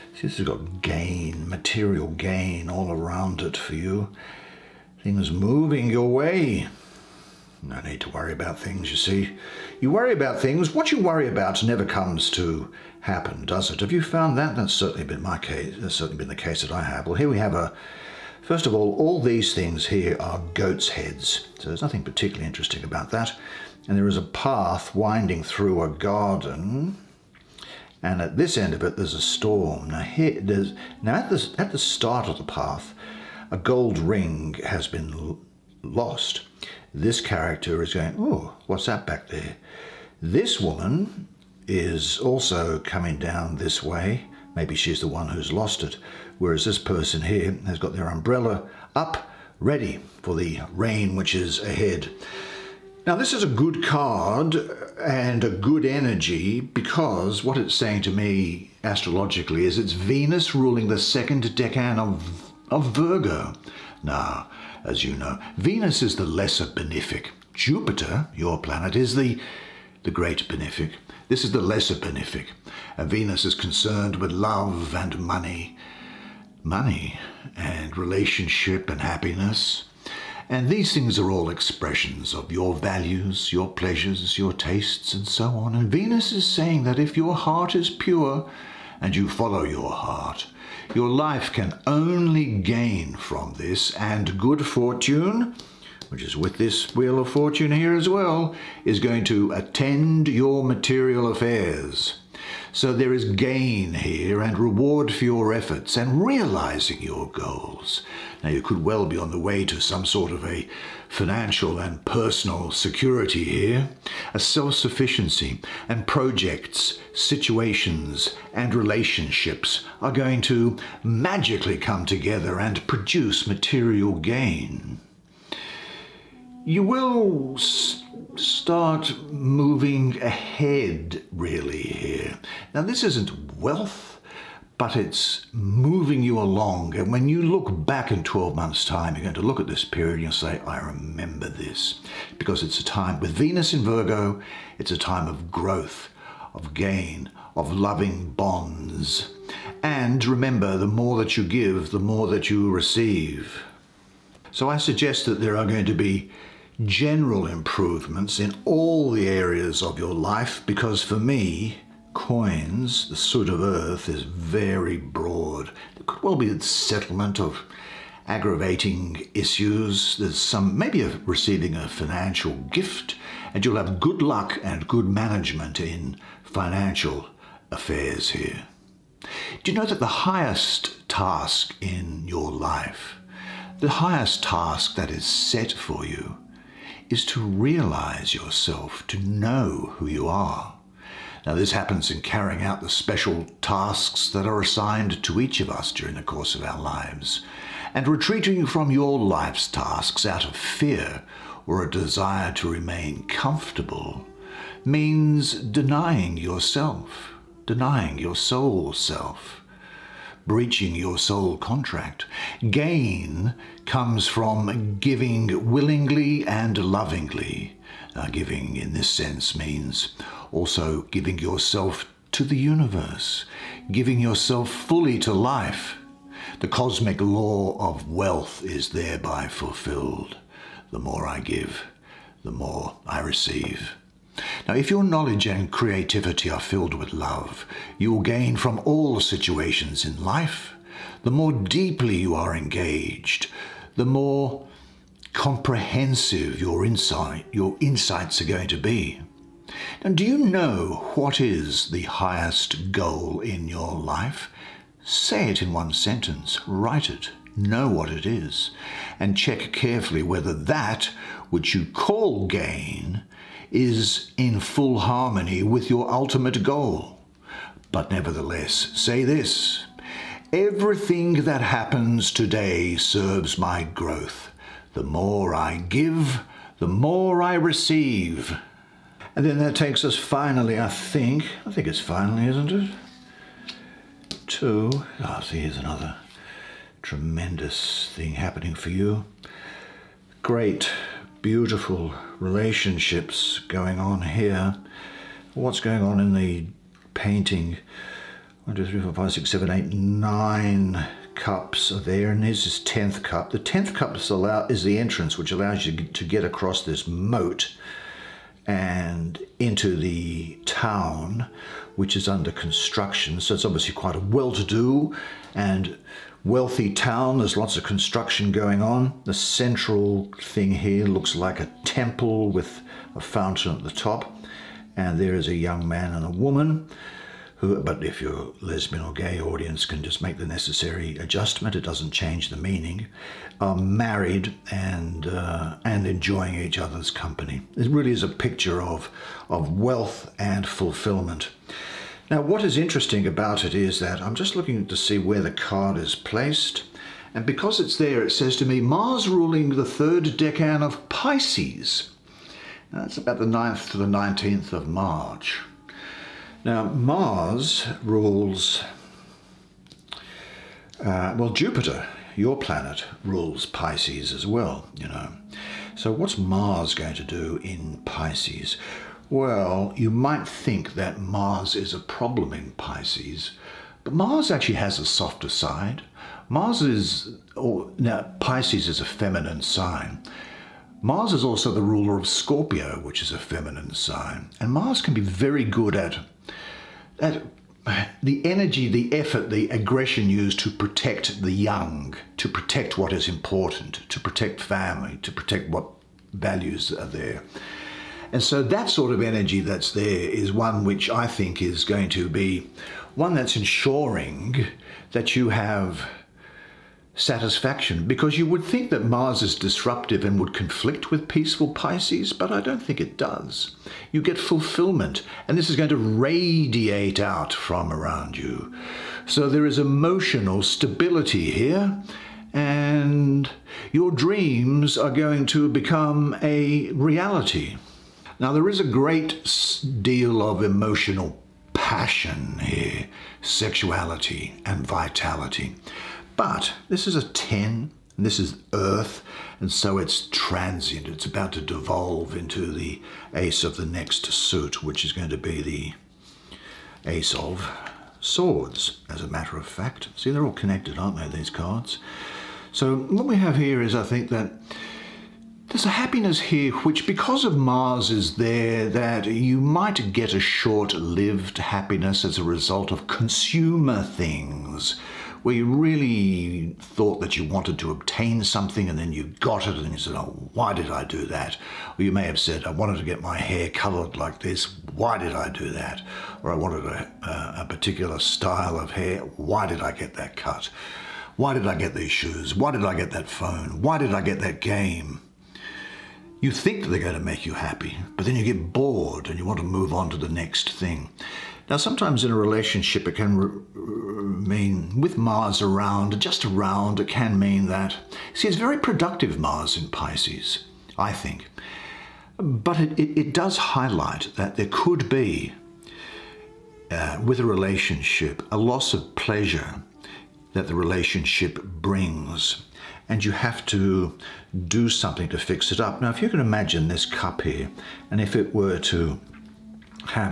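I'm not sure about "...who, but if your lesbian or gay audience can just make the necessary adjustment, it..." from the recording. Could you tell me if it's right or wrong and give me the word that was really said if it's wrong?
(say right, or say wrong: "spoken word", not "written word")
right.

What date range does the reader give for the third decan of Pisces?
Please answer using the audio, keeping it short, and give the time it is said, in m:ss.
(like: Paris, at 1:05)
9th to 19th of March, at 5:53.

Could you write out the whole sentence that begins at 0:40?
This woman is also coming down this way.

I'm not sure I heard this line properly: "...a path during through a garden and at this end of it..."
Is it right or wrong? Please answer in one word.
wrong.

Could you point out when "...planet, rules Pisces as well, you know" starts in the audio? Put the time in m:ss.
6:02.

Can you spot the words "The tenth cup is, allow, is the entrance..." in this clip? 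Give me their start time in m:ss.
5:03.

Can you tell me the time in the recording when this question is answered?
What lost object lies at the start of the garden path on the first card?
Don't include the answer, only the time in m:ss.
0:33.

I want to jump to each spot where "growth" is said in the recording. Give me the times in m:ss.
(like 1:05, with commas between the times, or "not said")
2:25, 4:33.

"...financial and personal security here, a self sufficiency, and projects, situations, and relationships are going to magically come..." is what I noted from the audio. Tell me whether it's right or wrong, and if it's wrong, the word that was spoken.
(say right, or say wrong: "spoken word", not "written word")
right.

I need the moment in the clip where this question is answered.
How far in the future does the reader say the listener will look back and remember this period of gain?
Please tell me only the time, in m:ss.
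2:18.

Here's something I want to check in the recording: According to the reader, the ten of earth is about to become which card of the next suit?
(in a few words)
ace of swords.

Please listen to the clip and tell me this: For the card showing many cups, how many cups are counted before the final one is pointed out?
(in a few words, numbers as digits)
9.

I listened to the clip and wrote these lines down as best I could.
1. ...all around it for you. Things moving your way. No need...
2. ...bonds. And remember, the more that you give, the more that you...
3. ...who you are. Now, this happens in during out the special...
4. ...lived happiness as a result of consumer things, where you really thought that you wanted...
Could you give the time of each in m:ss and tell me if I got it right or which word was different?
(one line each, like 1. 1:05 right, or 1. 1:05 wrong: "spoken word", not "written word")
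1. 0:02 right
2. 2:28 right
3. 3:09 wrong: "carrying", not "during"
4. 7:40 right.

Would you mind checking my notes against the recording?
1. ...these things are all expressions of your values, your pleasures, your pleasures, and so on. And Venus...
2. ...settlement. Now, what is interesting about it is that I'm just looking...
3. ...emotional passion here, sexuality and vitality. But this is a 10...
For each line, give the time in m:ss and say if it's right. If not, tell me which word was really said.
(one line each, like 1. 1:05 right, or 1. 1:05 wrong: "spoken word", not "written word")
1. 1:20 wrong: "tastes", not "pleasures"
2. 5:40 wrong: "fulfillment", not "settlement"
3. 7:10 right.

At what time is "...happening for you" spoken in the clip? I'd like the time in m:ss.
4:48.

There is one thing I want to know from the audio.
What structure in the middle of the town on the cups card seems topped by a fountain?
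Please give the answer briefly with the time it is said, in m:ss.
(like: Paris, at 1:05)
a temple, at 5:21.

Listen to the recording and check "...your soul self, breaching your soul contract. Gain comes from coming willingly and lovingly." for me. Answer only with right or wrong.
wrong.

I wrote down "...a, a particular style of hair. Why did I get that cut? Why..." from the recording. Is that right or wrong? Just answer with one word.
right.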